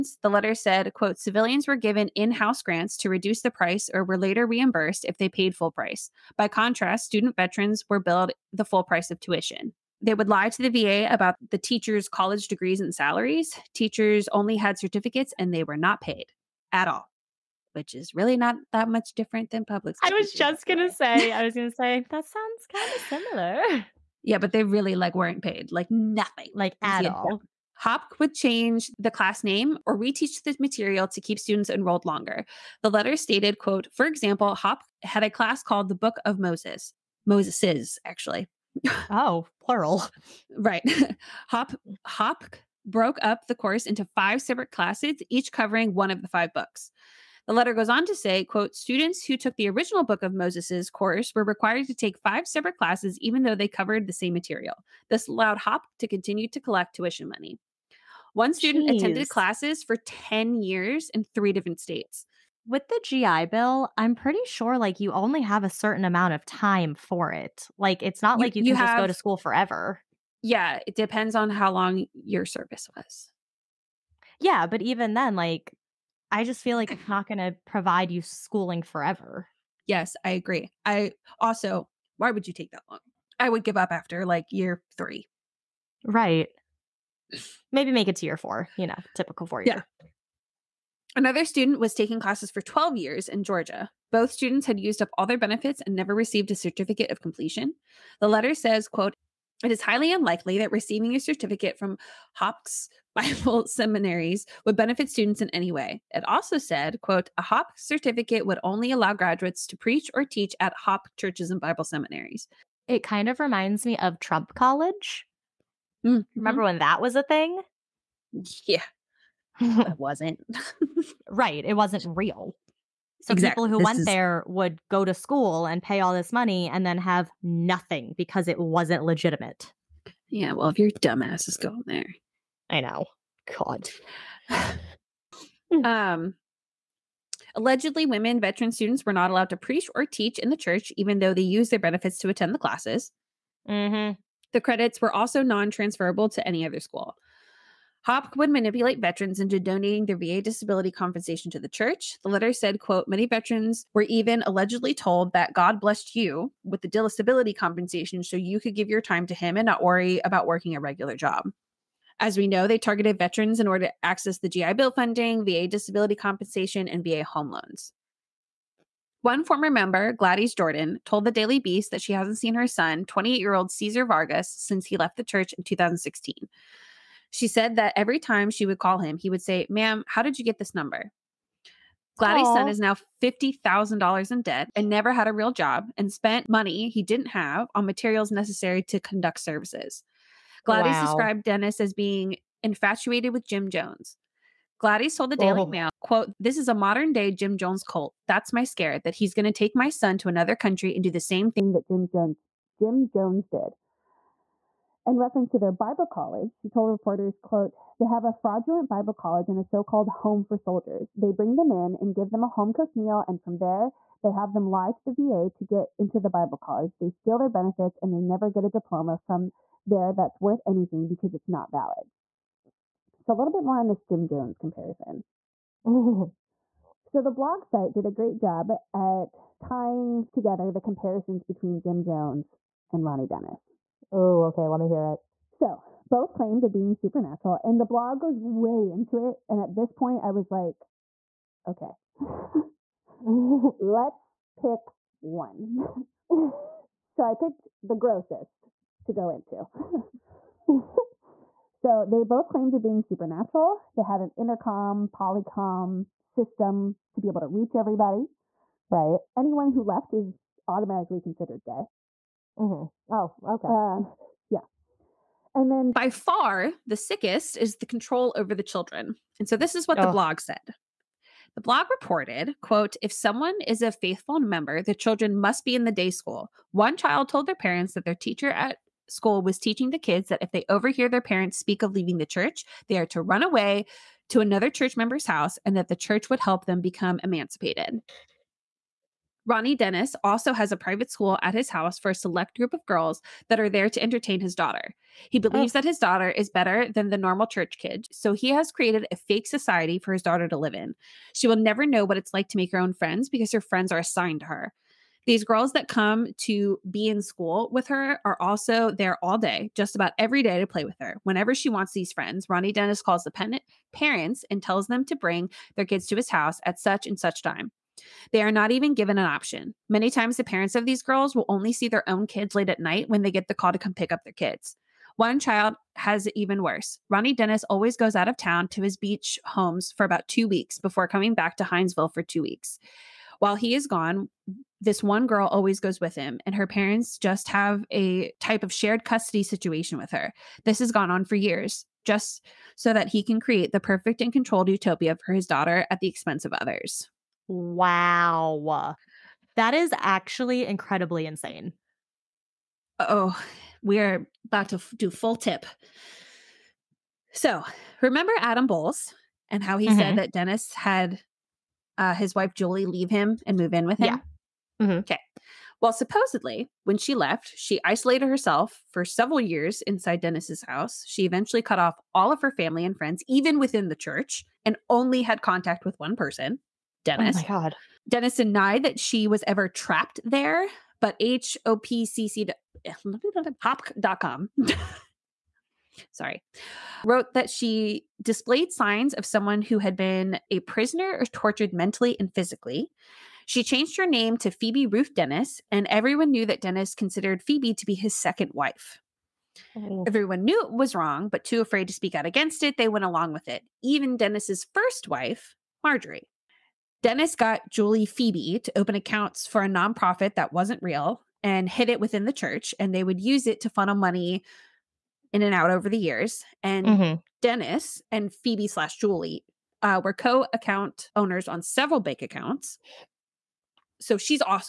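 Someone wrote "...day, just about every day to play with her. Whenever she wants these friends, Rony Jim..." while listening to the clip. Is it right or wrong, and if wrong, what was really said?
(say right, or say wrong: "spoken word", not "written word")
wrong: "Denis", not "Jim".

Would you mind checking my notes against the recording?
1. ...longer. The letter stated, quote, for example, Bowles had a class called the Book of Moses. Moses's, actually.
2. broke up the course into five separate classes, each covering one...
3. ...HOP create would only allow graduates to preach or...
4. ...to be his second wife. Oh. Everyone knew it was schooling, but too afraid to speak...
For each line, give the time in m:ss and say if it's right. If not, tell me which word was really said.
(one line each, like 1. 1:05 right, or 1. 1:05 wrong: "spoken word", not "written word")
1. 0:32 wrong: "HOP", not "Bowles"
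2. 0:42 right
3. 1:47 wrong: "certificate", not "create"
4. 6:37 wrong: "wrong", not "schooling".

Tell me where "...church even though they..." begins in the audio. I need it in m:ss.
2:20.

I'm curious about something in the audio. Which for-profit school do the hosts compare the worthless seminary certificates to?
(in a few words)
Trump College.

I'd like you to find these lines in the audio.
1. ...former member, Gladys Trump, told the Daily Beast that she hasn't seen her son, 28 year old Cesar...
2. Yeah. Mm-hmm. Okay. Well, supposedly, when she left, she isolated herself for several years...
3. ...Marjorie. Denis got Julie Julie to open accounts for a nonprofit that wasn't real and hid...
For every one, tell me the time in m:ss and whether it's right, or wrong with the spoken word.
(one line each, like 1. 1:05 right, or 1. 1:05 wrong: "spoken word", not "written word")
1. 2:49 wrong: "Jordan", not "Trump"
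2. 6:04 right
3. 6:45 wrong: "Phoebe", not "Julie".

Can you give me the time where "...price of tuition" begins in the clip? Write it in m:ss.
0:08.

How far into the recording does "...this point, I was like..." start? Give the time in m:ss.
3:59.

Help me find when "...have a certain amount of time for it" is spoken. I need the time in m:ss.
1:05.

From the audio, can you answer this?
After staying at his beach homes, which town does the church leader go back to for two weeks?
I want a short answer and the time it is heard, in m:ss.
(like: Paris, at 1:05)
Hinesville, at 5:31.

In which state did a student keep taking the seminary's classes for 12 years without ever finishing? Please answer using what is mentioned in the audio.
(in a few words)
Georgia.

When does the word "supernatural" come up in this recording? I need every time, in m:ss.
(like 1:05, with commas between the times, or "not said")
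3:56, 4:13.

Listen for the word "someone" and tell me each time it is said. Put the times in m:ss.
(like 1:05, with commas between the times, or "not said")
4:33, 6:29.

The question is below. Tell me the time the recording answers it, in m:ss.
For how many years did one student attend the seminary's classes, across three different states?
0:59.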